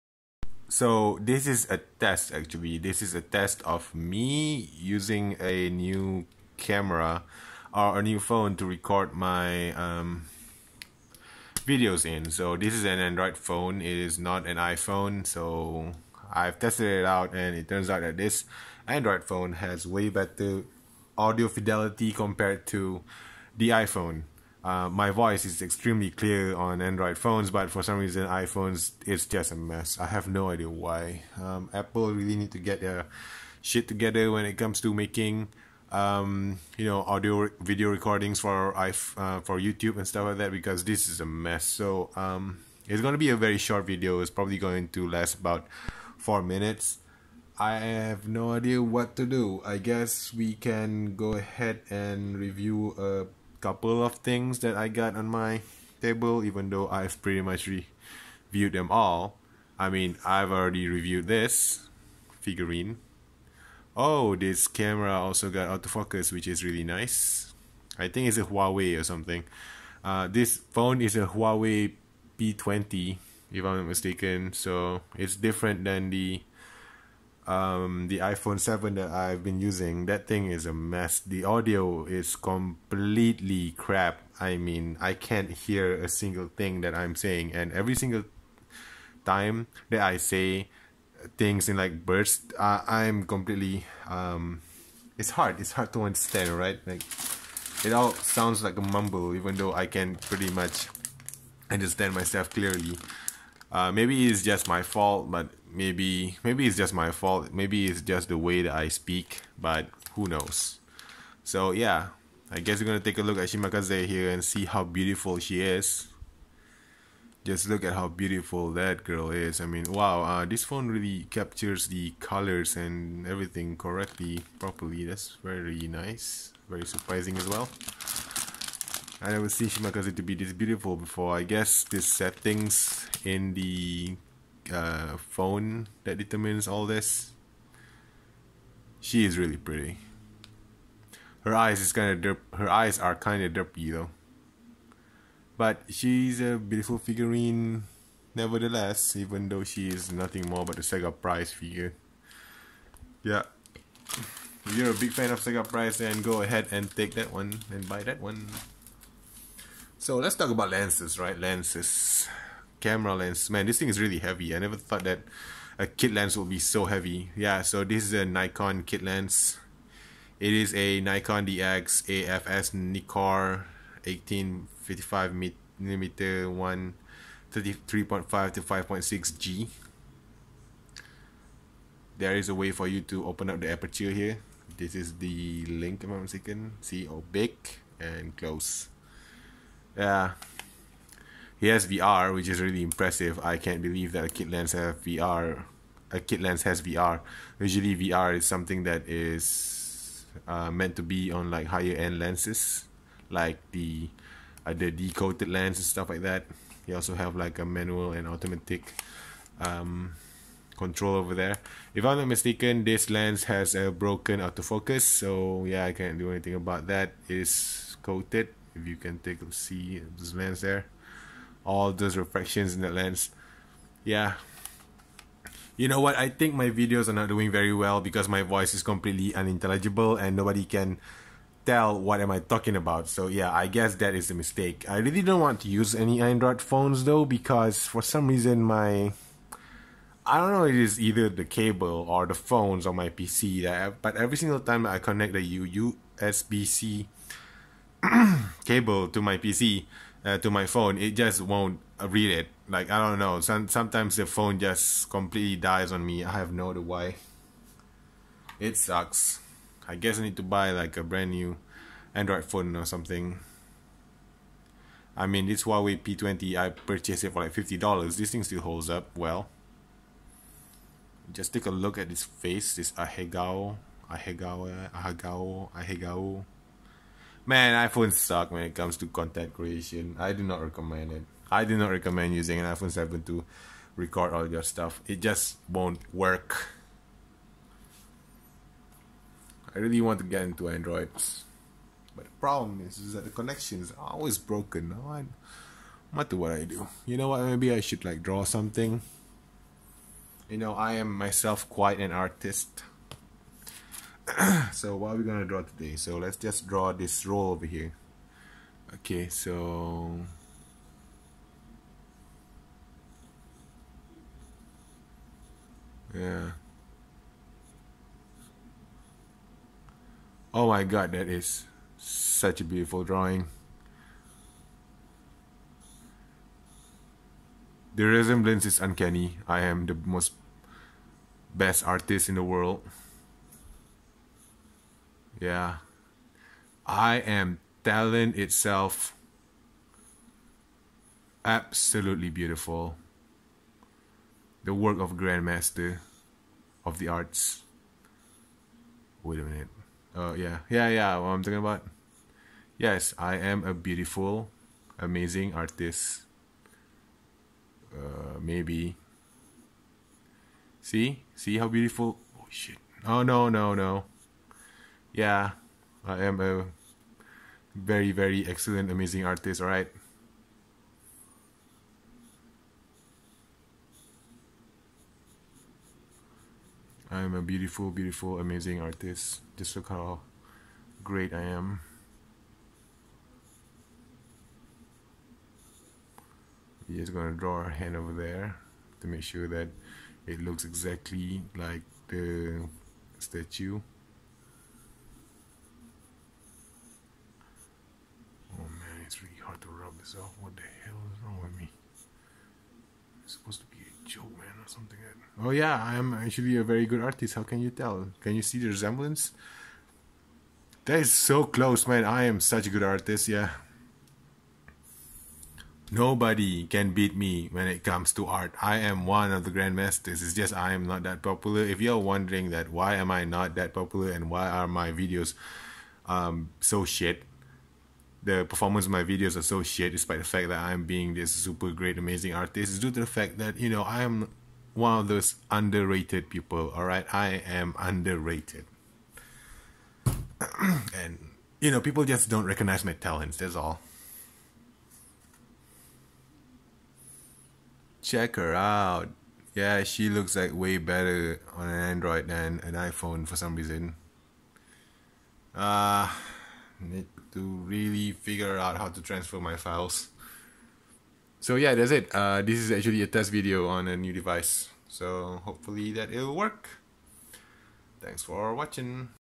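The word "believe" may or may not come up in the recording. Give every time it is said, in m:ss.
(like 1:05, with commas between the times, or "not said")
3:13.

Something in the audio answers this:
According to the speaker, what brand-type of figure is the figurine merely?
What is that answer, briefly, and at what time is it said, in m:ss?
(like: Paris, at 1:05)
Sega Prize figure, at 2:30.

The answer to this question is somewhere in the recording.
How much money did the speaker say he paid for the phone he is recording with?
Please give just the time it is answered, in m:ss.
4:27.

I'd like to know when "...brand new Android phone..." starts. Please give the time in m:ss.
4:21.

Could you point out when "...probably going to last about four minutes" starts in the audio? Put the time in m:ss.
0:44.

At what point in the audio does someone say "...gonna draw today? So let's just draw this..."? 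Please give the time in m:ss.
5:05.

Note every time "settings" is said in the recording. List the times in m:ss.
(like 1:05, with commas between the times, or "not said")
2:12.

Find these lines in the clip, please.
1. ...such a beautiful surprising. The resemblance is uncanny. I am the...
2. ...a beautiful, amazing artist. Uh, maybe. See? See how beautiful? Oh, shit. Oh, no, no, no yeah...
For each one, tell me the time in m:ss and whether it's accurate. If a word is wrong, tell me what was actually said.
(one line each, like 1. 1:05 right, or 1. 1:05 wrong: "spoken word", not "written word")
1. 5:21 wrong: "drawing", not "surprising"
2. 5:53 right.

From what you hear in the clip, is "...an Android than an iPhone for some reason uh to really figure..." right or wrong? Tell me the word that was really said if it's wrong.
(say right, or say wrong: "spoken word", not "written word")
right.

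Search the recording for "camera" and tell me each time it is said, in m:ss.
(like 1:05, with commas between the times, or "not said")
0:06, 1:04, 2:42.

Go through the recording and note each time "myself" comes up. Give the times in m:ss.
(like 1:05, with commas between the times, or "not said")
1:42, 5:01.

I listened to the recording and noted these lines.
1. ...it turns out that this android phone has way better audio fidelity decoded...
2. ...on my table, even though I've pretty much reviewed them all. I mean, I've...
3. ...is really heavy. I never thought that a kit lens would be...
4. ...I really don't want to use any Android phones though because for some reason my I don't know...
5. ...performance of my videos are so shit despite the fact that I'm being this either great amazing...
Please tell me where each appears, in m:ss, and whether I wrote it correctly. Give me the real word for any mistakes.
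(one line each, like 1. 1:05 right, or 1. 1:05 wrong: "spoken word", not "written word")
1. 0:17 wrong: "compared", not "decoded"
2. 0:55 right
3. 2:43 right
4. 3:54 right
5. 7:08 wrong: "super", not "either".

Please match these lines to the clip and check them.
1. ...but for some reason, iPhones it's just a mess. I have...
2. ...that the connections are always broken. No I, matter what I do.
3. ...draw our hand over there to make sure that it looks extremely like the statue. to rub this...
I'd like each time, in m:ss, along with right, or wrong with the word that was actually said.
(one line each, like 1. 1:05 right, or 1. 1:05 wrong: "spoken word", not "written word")
1. 0:27 right
2. 4:53 right
3. 6:27 wrong: "exactly", not "extremely".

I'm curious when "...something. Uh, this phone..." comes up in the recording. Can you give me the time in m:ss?
1:09.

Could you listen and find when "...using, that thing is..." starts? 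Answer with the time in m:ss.
1:19.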